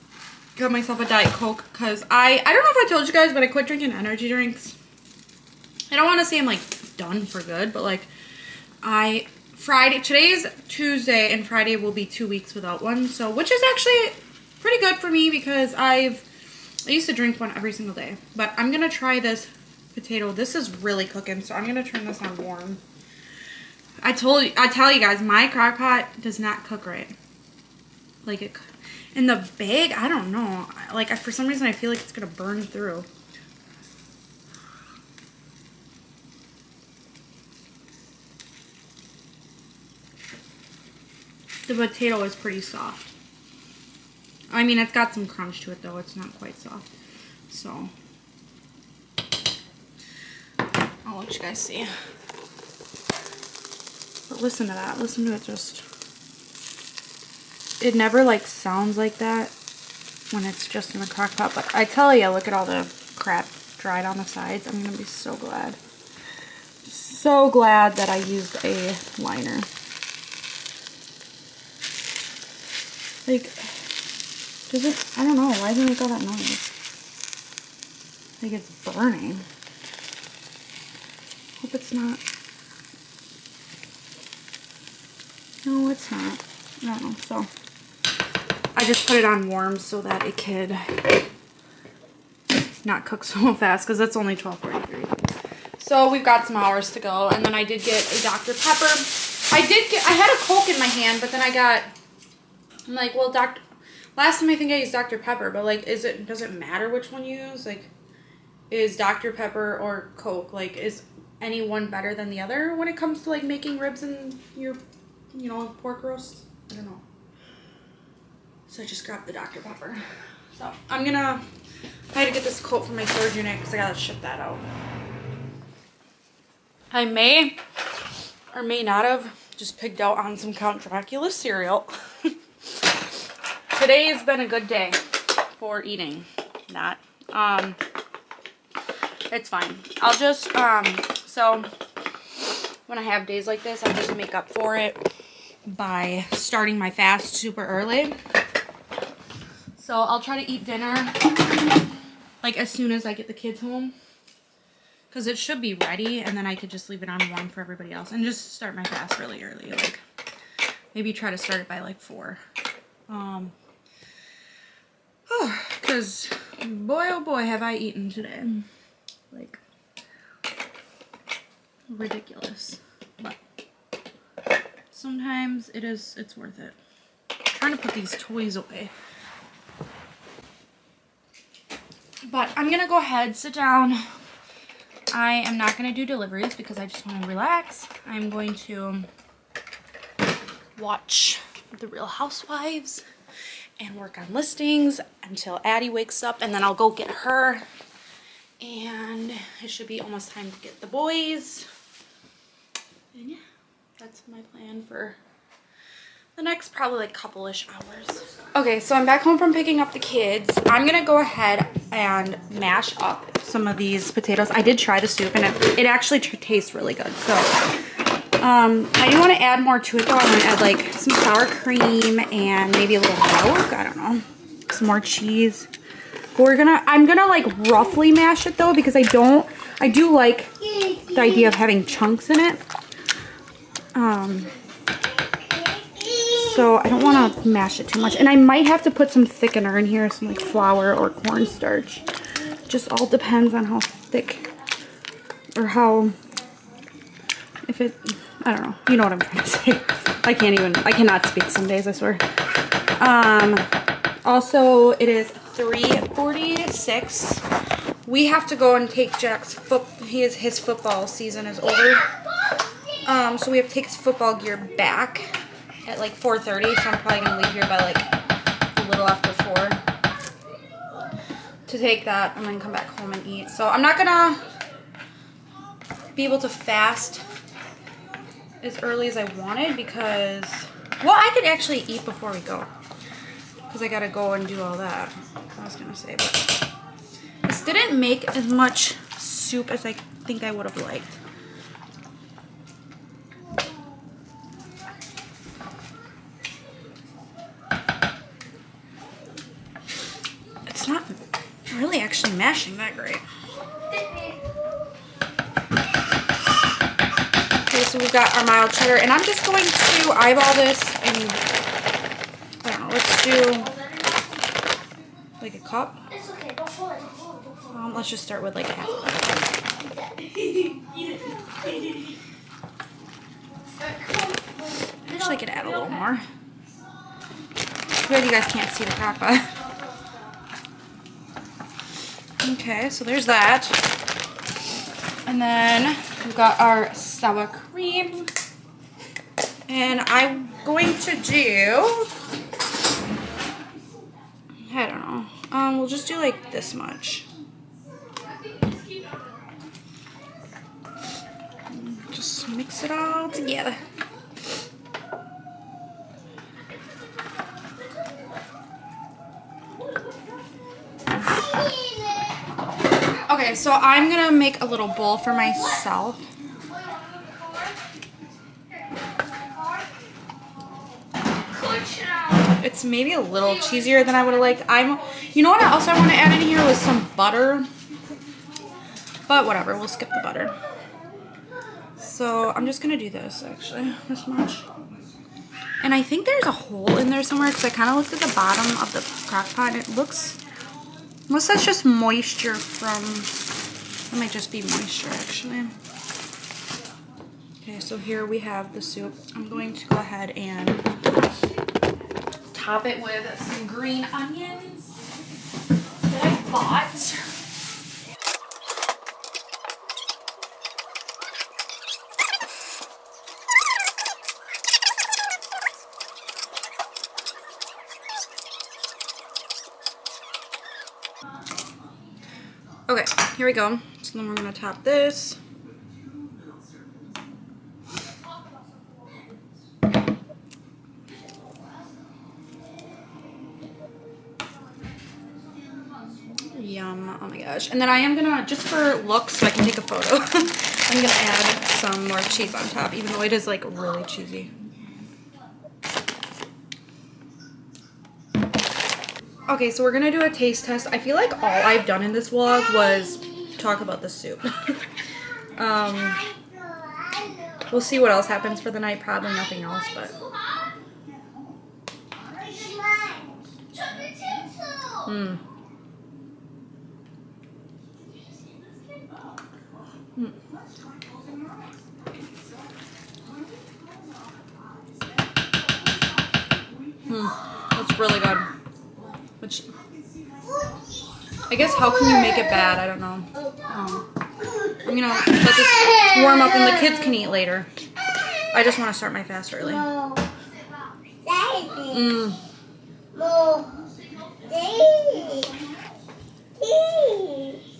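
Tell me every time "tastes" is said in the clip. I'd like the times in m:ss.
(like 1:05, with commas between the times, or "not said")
3:36, 7:30.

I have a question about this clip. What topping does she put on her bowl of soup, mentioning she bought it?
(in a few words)
green onions.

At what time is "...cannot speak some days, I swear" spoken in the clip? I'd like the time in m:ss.
4:10.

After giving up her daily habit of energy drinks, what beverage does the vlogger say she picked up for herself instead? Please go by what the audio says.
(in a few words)
Diet Coke.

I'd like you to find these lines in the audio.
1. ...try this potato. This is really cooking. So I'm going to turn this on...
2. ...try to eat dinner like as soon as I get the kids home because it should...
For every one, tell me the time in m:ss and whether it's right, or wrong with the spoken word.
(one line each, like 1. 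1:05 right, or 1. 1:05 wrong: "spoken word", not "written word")
1. 0:18 right
2. 2:30 right.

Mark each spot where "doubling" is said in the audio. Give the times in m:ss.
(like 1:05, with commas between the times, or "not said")
not said.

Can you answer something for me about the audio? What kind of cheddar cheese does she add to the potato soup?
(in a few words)
mild cheddar.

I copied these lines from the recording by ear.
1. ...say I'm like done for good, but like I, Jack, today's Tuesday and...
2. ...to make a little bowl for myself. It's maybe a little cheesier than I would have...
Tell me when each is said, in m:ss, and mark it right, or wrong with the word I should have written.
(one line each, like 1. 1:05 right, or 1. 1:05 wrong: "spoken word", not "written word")
1. 0:06 wrong: "Friday", not "Jack"
2. 6:04 right.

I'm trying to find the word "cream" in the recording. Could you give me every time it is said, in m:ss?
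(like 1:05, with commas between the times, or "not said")
3:41, 5:37.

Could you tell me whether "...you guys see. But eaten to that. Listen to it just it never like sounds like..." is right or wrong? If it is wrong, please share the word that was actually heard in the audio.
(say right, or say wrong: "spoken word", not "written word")
wrong: "listen", not "eaten".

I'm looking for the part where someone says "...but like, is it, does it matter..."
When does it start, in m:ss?
1:45.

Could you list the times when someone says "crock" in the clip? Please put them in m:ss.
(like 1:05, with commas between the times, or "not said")
0:25, 1:01, 6:29.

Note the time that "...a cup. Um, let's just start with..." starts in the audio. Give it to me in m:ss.
5:15.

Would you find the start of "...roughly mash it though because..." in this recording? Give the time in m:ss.
3:47.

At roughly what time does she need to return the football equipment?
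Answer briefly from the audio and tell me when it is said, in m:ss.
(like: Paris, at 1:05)
4:30, at 4:26.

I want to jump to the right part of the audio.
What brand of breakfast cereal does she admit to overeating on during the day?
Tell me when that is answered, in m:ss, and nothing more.
2:10.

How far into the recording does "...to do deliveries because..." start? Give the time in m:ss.
3:05.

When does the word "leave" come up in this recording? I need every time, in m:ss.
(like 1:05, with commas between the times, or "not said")
2:36, 4:27.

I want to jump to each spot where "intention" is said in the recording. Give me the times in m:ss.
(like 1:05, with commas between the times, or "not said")
not said.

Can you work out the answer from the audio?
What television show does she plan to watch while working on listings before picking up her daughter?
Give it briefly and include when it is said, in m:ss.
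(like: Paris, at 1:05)
The Real Housewives, at 3:11.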